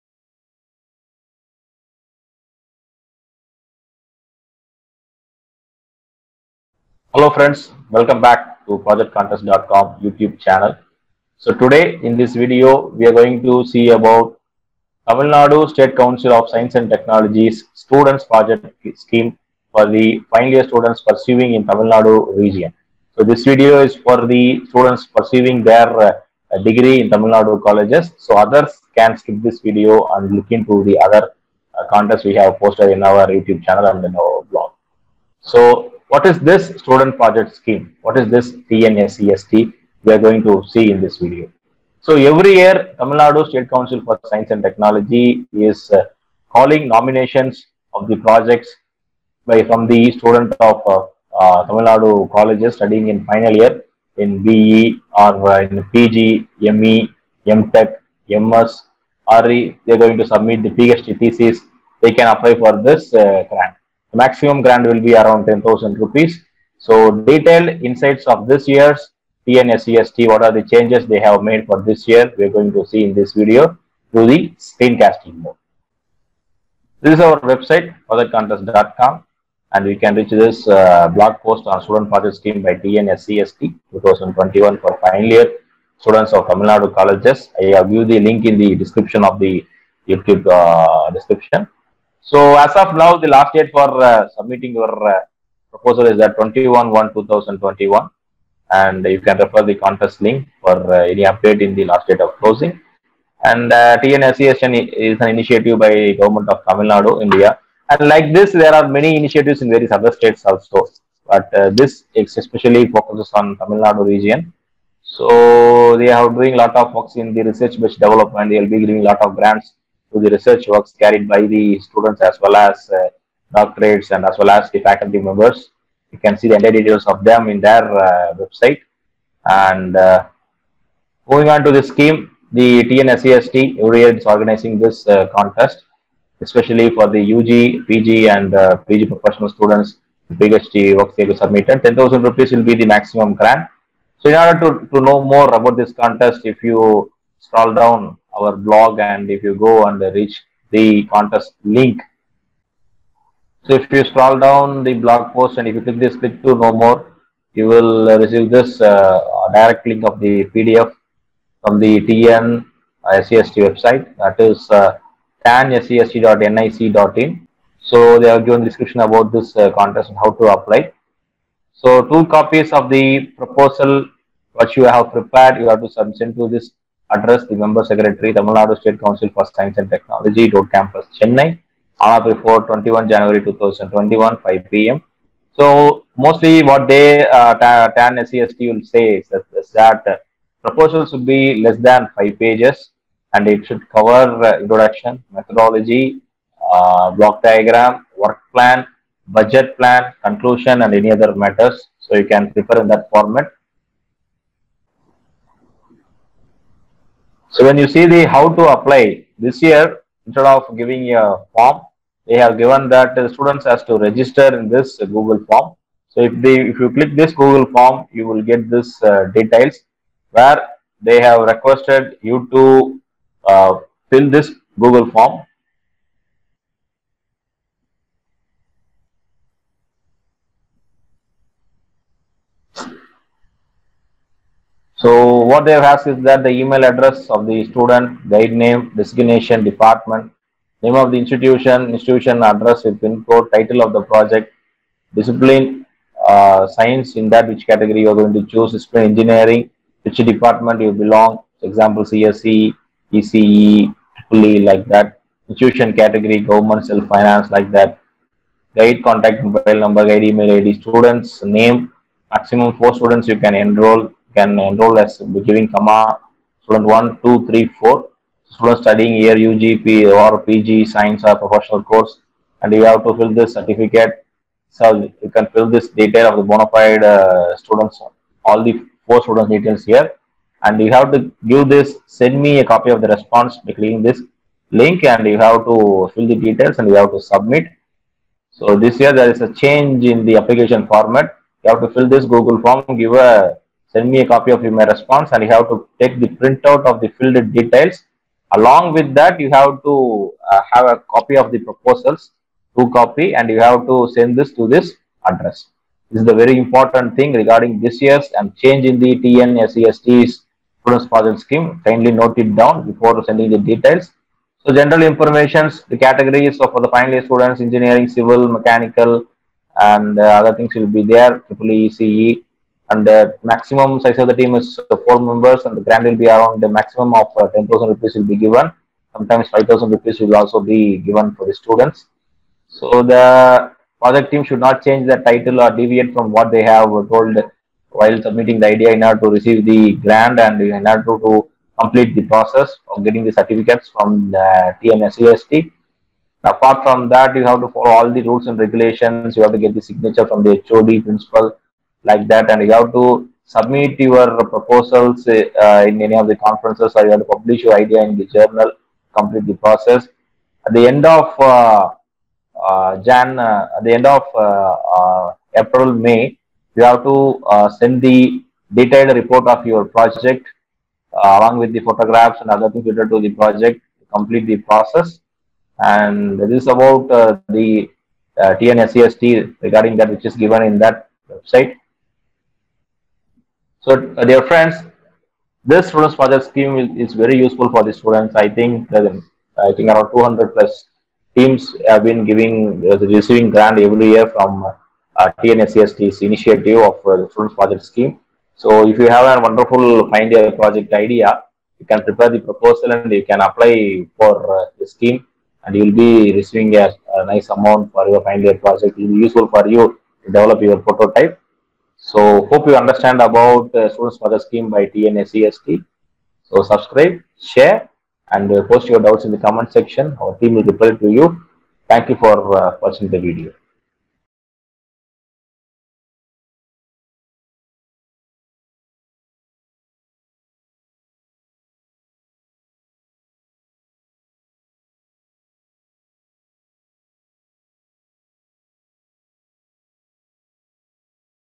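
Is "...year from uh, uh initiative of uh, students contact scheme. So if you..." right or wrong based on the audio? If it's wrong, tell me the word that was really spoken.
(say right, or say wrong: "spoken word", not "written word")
wrong: "project", not "contact".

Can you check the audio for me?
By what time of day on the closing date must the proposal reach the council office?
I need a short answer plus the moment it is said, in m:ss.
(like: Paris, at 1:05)
5 p.m., at 3:04.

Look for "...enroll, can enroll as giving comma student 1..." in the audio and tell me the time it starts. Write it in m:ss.
4:23.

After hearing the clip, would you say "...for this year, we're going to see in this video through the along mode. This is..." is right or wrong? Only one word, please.
wrong.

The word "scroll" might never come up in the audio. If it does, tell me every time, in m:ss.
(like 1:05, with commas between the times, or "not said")
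2:27, 2:34.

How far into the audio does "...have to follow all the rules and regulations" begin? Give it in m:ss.
5:47.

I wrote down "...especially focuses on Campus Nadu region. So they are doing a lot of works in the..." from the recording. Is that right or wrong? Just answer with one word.
wrong.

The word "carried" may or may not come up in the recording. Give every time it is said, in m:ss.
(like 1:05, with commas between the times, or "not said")
2:00.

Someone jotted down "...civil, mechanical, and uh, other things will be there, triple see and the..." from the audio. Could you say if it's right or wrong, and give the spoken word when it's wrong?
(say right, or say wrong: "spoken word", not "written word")
right.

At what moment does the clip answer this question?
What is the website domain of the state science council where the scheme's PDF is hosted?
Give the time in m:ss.
2:45.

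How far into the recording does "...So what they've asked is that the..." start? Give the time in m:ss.
3:55.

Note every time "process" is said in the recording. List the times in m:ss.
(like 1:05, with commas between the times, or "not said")
5:42, 5:59, 6:14.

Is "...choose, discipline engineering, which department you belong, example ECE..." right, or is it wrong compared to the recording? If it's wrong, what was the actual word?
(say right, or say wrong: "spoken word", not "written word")
wrong: "CSE", not "ECE".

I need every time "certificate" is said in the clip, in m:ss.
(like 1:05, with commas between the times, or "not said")
4:33, 5:43.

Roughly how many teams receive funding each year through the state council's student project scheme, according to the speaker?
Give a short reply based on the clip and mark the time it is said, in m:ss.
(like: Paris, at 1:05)
200 plus, at 6:30.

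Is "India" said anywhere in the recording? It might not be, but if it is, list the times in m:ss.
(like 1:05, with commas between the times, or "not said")
1:47.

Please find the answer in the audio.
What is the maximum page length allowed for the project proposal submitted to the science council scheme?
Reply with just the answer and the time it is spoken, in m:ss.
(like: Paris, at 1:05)
5 pages, at 3:12.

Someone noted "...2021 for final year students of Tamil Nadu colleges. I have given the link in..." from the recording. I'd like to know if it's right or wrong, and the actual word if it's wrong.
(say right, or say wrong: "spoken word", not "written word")
right.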